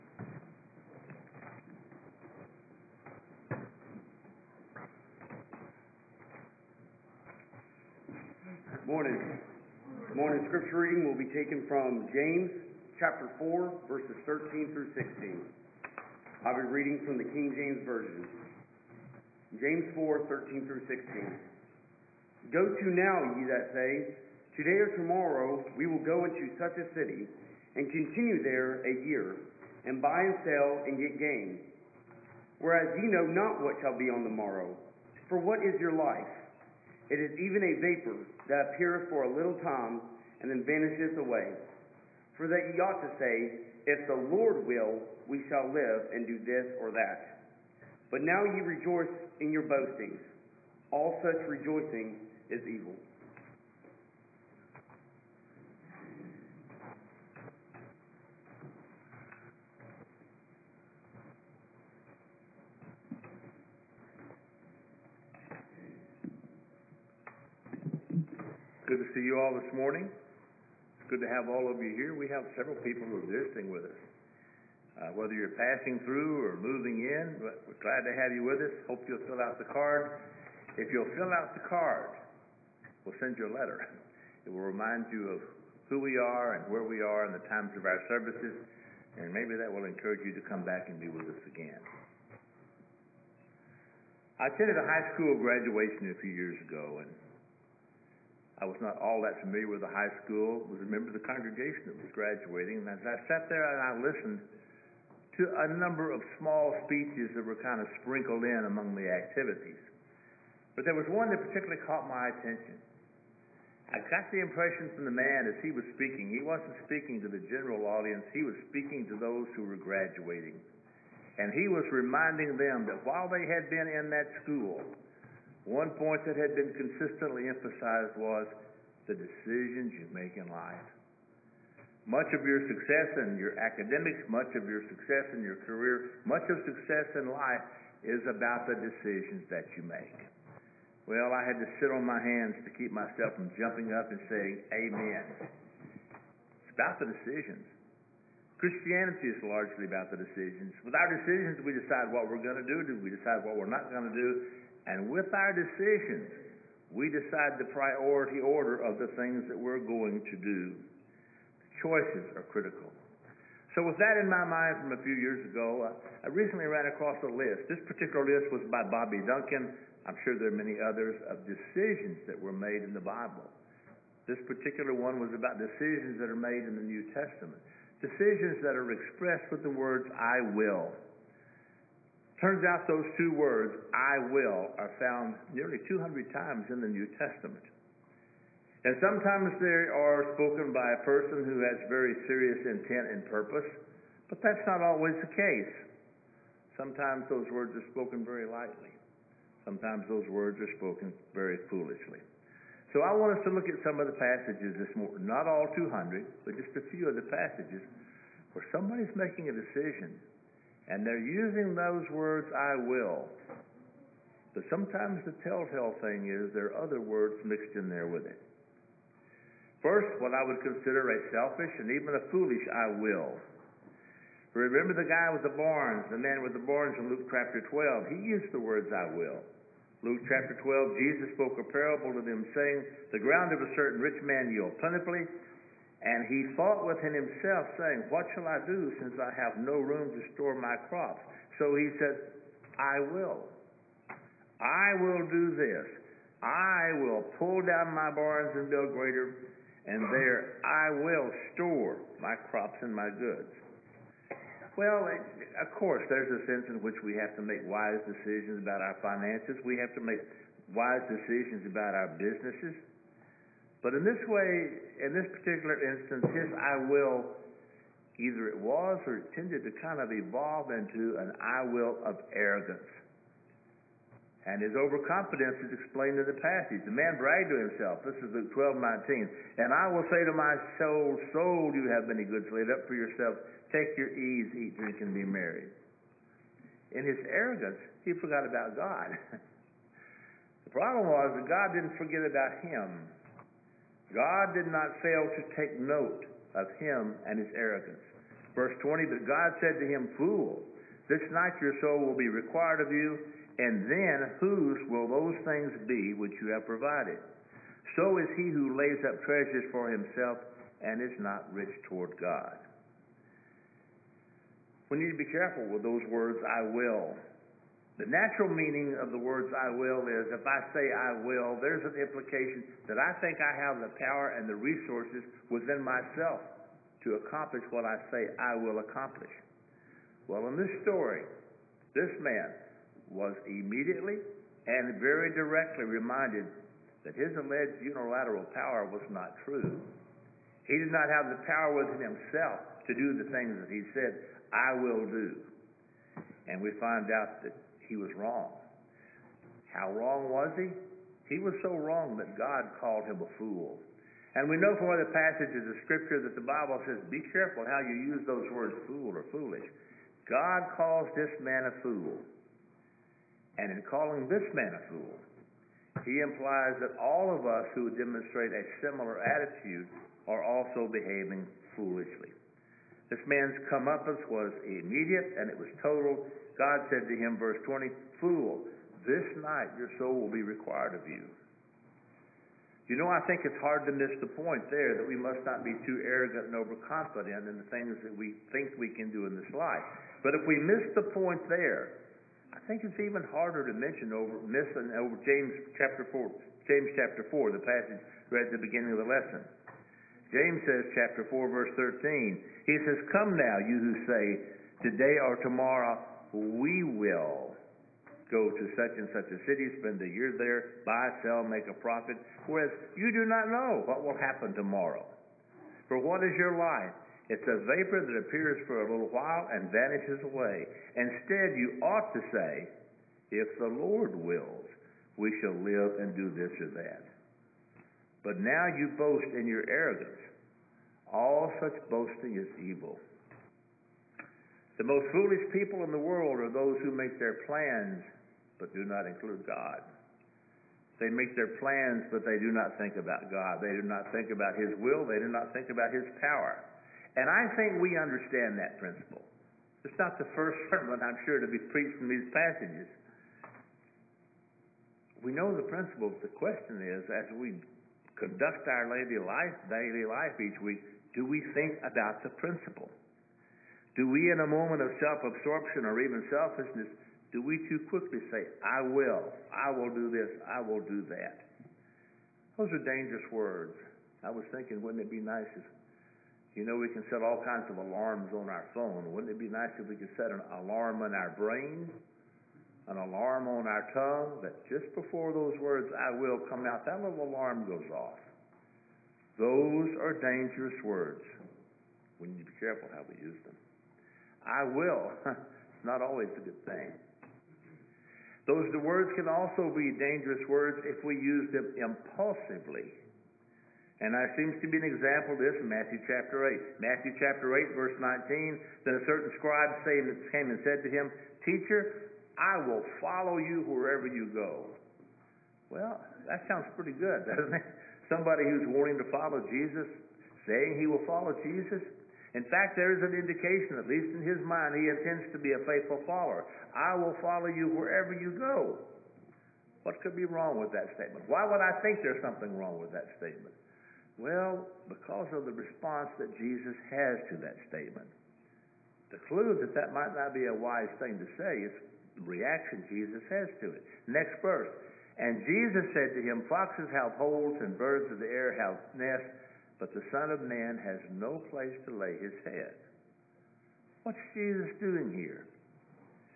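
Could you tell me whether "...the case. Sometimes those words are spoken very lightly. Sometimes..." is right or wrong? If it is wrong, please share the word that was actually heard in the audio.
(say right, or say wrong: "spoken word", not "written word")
right.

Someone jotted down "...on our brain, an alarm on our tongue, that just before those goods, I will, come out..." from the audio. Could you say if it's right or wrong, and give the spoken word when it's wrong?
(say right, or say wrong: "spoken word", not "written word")
wrong: "words", not "goods".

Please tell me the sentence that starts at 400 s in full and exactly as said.
James says, chapter four, verse thirteen.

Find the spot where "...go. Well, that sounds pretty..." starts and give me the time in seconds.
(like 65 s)
514 s.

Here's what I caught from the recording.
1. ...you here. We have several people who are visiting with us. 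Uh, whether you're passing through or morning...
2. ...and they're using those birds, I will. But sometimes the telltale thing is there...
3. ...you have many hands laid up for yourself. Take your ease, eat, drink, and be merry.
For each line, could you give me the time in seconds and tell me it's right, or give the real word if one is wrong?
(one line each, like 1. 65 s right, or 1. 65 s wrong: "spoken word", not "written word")
1. 71 s wrong: "moving", not "morning"
2. 210 s wrong: "words", not "birds"
3. 281 s wrong: "goods", not "hands".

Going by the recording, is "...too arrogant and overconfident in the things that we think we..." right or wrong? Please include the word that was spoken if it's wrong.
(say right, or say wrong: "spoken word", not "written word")
right.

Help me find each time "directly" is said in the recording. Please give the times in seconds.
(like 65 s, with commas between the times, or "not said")
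335 s.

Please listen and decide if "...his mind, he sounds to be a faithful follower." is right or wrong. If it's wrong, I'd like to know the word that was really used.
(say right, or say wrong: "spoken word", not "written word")
wrong: "intends", not "sounds".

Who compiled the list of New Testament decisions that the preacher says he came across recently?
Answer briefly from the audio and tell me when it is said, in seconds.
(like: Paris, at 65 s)
Bobby Duncan, at 168 s.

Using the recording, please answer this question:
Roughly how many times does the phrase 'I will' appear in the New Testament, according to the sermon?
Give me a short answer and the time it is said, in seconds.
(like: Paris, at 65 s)
nearly 200, at 185 s.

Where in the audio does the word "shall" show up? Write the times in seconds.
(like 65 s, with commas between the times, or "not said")
33 s, 45 s, 238 s, 425 s.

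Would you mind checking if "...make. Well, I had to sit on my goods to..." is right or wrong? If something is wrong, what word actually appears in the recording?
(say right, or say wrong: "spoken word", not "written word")
wrong: "hands", not "goods".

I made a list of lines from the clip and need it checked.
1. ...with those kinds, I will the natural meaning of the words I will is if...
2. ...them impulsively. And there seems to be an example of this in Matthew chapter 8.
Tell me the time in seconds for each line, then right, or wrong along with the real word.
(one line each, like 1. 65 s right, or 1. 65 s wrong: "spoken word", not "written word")
1. 315 s wrong: "words", not "kinds"
2. 501 s right.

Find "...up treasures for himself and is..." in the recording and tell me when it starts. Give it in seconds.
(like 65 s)
309 s.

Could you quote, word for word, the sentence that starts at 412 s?
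Whereas you do not know what will happen tomorrow.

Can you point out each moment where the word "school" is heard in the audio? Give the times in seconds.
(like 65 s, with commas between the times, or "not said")
95 s, 100 s, 124 s.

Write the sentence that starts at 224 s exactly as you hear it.
Remember the guy with the barns, the man with the barns in Luke chapter 12.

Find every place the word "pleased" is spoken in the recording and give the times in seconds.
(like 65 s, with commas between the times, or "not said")
not said.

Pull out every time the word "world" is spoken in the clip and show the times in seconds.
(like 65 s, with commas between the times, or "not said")
435 s.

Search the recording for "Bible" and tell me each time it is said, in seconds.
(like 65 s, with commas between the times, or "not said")
173 s, 356 s.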